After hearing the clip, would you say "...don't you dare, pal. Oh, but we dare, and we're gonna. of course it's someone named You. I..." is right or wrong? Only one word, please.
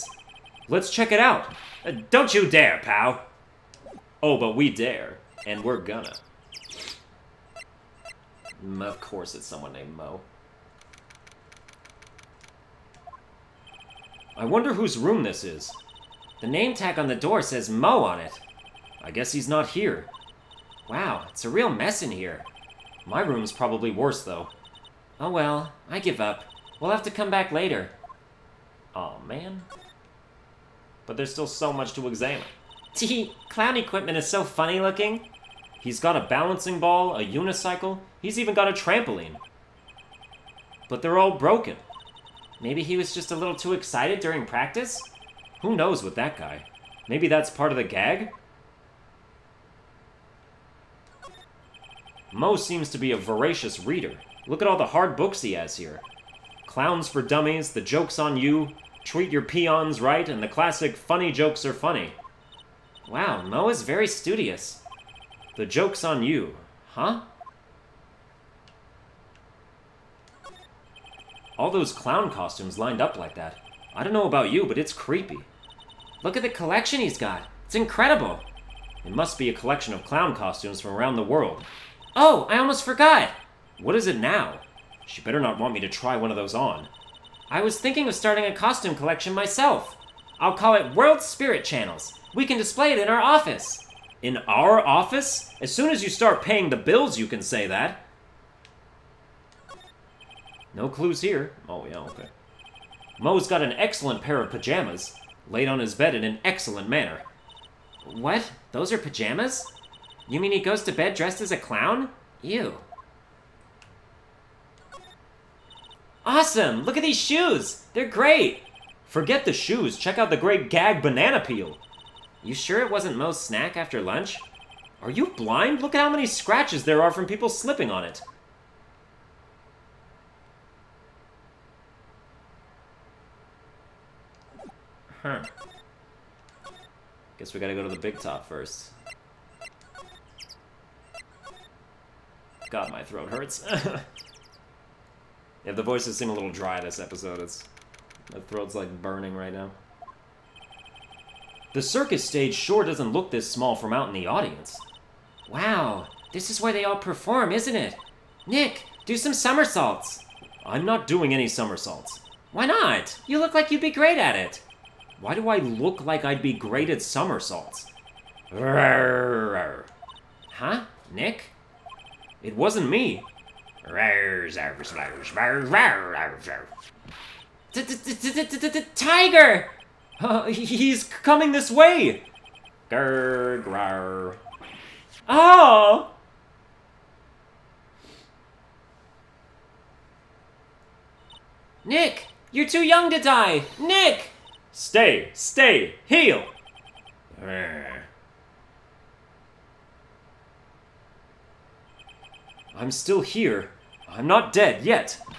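wrong.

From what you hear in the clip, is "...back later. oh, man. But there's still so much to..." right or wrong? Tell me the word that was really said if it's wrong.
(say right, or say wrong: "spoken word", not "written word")
right.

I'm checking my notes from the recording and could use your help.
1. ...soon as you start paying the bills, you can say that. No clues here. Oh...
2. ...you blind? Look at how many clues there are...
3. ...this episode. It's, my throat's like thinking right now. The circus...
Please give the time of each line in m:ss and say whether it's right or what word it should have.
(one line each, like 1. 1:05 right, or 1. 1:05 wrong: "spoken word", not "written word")
1. 1:35 right
2. 2:05 wrong: "scratches", not "clues"
3. 2:26 wrong: "burning", not "thinking".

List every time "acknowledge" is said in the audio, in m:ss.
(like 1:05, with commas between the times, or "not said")
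not said.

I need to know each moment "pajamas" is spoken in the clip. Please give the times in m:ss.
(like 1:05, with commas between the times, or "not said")
1:44, 1:48.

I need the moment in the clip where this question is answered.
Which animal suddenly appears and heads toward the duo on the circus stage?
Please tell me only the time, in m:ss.
2:58.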